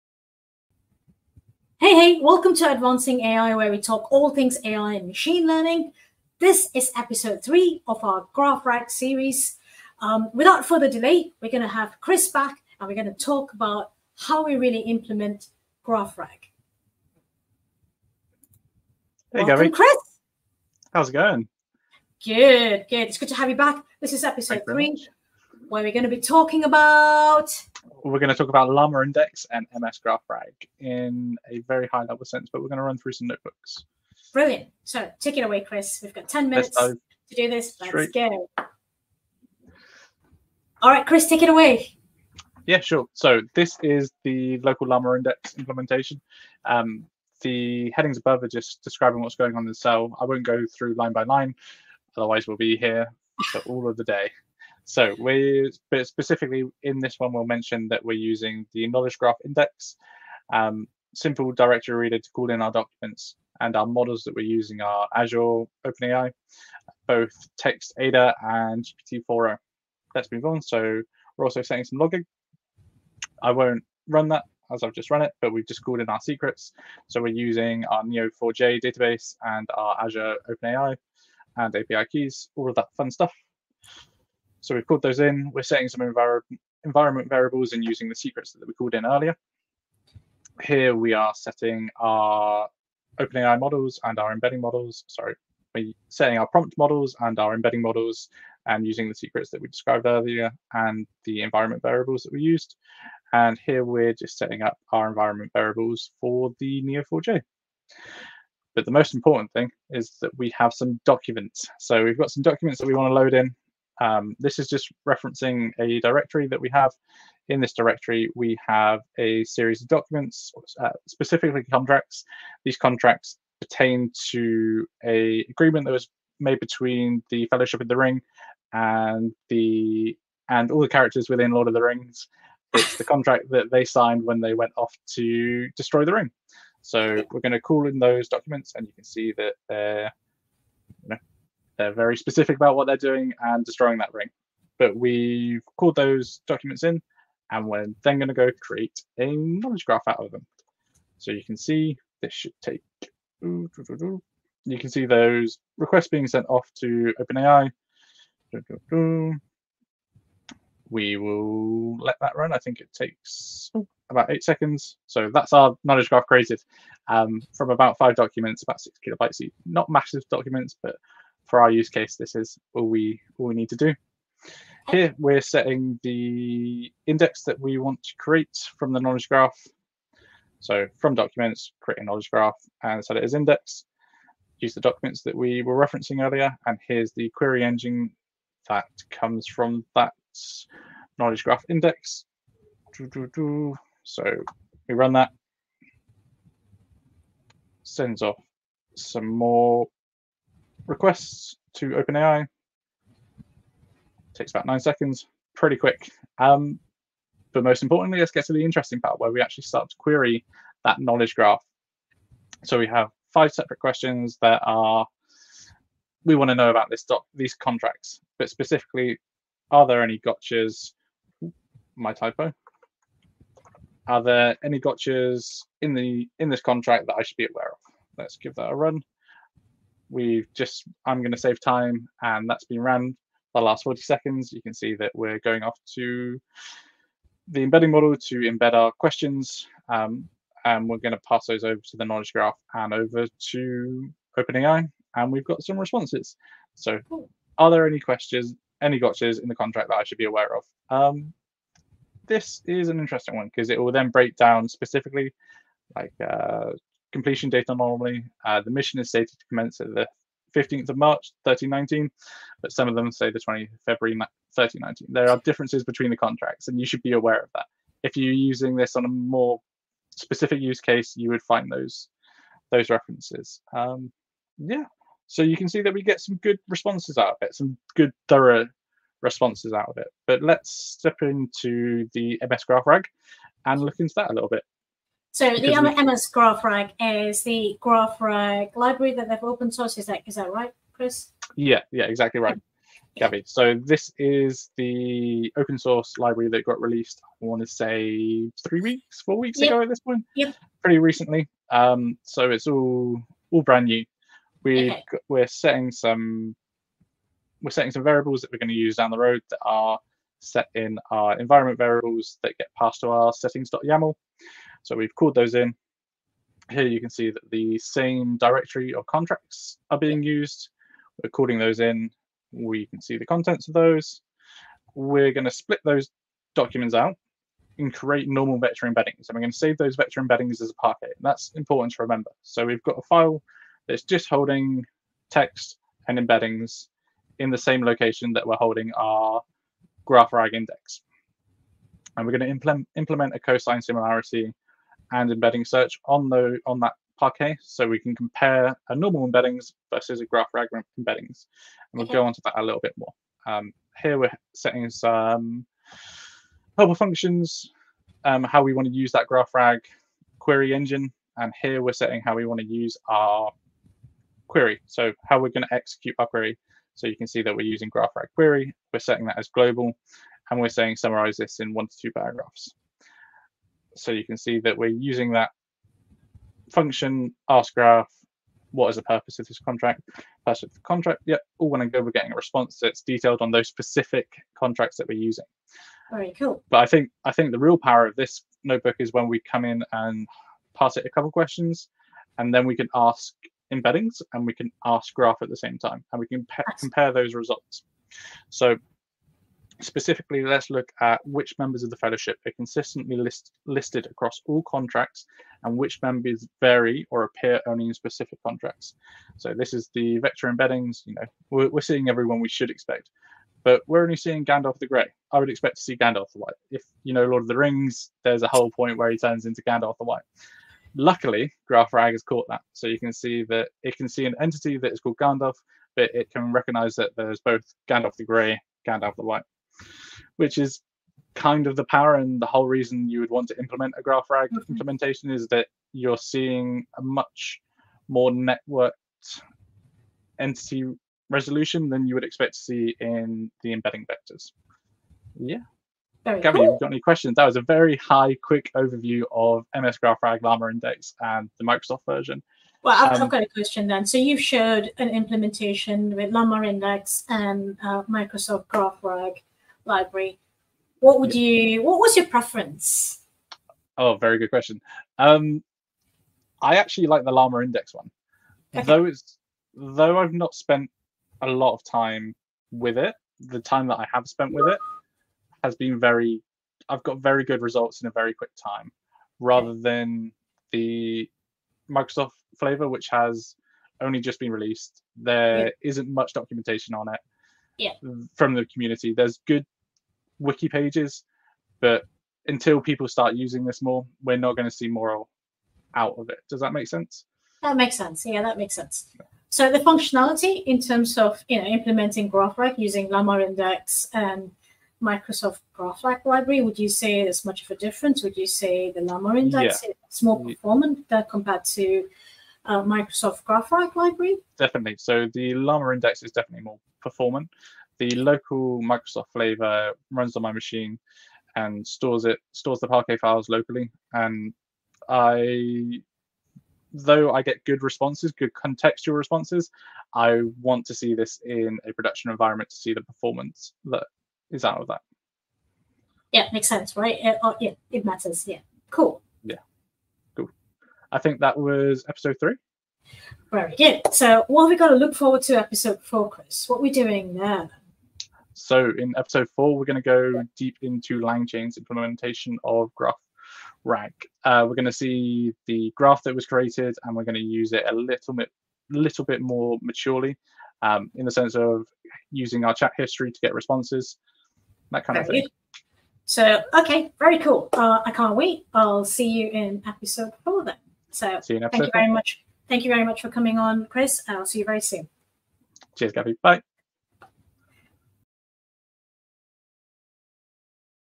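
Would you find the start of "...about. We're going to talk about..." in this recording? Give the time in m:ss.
0:26.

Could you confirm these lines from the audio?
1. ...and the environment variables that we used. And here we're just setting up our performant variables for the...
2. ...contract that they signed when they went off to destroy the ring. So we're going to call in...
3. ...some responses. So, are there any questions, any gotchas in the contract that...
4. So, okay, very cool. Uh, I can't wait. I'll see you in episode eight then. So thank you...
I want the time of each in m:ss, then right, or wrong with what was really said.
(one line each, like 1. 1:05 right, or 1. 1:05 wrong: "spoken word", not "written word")
1. 1:40 wrong: "environment", not "performant"
2. 2:13 right
3. 4:05 right
4. 9:26 wrong: "four", not "eight".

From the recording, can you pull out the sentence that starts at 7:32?
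Well, I've, um, got a question then.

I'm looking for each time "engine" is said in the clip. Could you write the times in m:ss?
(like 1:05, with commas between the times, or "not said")
3:07, 6:00.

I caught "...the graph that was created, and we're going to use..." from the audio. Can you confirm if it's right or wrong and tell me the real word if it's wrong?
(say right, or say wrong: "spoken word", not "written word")
right.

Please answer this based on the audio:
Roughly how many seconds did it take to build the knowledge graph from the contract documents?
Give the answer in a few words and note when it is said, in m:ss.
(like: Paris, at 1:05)
8, at 2:44.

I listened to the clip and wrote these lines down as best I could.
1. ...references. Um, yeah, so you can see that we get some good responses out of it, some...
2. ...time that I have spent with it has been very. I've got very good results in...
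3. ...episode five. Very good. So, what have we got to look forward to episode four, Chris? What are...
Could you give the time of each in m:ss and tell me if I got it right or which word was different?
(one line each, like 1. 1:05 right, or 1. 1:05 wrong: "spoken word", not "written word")
1. 4:32 right
2. 7:53 right
3. 9:02 wrong: "three", not "five".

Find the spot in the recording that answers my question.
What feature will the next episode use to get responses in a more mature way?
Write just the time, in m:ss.
9:22.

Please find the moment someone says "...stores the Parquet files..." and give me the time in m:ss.
8:42.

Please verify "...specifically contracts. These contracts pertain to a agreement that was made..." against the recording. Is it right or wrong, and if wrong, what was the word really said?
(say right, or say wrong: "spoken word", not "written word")
right.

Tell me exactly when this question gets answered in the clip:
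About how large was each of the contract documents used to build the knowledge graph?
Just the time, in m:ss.
2:48.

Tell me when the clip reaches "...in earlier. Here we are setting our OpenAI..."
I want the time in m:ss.
1:28.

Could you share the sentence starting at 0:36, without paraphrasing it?
We've got 10 minutes to do this.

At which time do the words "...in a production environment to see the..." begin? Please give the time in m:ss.
8:51.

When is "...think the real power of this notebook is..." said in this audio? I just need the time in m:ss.
6:27.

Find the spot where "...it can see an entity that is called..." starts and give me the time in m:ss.
7:03.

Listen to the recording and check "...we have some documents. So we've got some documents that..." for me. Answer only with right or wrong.
right.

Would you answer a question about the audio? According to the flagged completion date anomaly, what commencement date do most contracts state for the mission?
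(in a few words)
15 March 1319.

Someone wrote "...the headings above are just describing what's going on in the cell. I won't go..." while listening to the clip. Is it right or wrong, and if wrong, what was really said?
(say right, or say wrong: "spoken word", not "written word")
right.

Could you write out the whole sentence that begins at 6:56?
If you know Lord of the Rings, there's a whole point where he turns into Gandalf the White.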